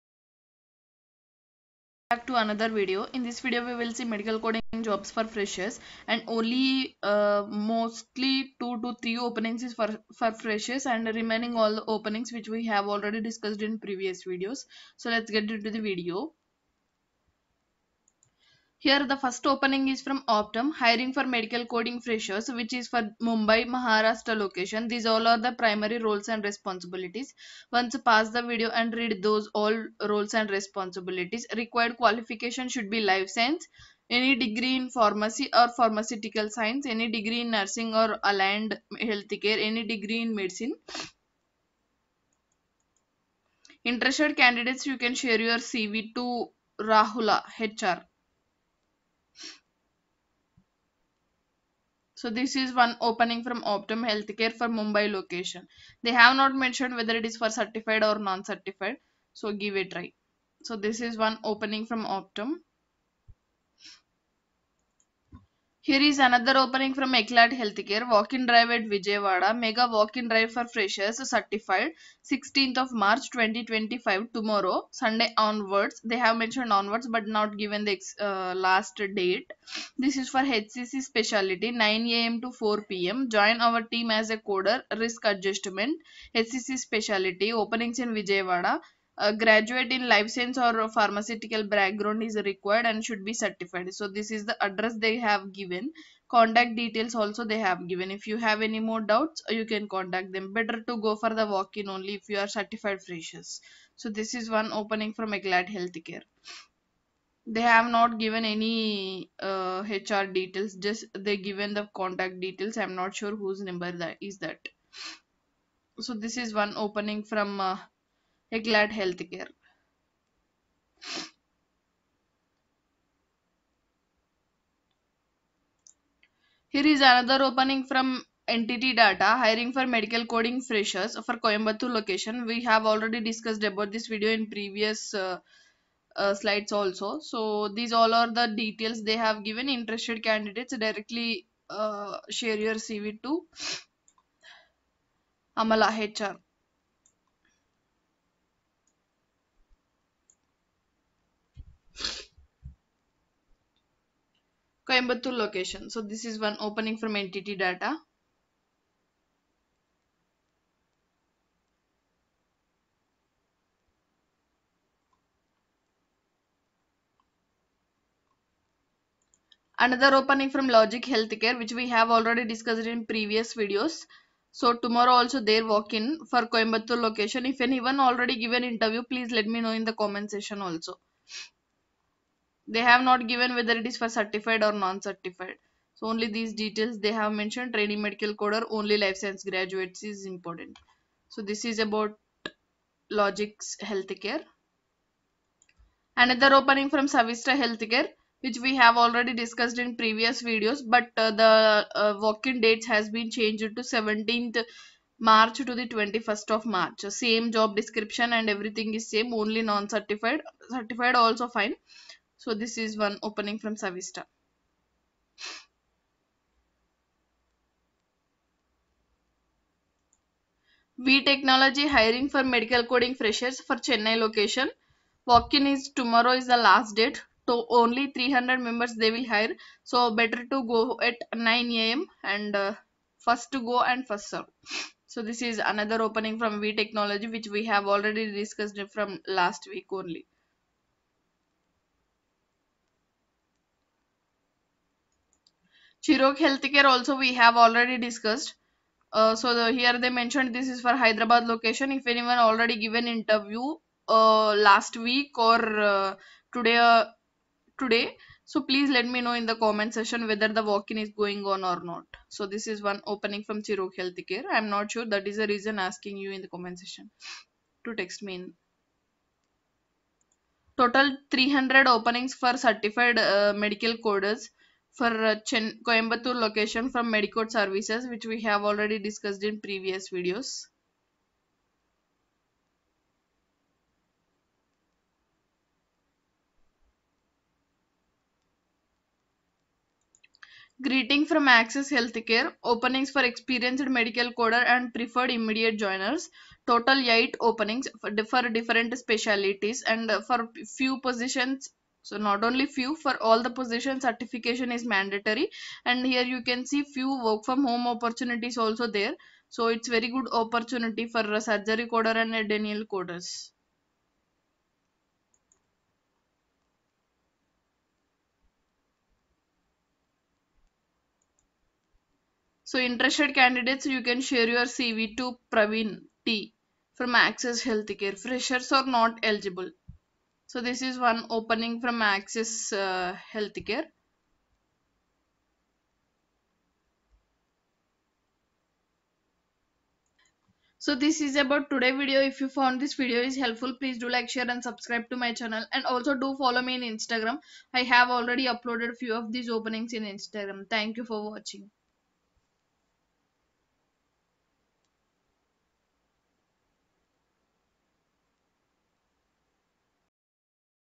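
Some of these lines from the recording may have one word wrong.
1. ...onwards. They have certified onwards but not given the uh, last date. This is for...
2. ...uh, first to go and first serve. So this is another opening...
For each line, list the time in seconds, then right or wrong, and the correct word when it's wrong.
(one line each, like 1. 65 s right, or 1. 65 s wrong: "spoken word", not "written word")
1. 75 s wrong: "mentioned", not "certified"
2. 232 s right.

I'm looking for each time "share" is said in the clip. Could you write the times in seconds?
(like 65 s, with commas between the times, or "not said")
45 s, 142 s, 324 s, 344 s.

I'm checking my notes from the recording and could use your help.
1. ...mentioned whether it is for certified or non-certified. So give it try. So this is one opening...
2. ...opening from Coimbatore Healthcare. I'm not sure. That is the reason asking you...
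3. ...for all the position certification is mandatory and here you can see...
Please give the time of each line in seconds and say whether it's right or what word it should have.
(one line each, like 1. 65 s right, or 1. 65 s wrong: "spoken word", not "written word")
1. 56 s right
2. 263 s wrong: "Chirog", not "Coimbatore"
3. 302 s right.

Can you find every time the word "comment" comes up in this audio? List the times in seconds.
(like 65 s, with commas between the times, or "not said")
179 s, 259 s, 266 s.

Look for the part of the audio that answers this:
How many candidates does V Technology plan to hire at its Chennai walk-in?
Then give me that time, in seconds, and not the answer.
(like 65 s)
228 s.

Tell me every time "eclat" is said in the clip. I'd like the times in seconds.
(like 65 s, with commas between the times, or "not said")
67 s, 105 s.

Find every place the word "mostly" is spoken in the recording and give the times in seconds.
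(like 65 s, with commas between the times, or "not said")
7 s.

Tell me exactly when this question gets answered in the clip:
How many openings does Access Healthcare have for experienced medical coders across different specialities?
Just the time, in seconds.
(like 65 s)
296 s.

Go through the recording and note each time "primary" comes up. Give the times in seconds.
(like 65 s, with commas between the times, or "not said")
25 s.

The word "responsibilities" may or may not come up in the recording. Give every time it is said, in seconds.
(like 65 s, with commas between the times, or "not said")
26 s, 30 s.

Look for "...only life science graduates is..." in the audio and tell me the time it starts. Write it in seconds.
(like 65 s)
188 s.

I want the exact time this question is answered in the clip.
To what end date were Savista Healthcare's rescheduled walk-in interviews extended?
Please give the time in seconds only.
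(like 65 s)
205 s.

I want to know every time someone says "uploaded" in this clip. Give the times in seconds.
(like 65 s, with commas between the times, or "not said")
348 s.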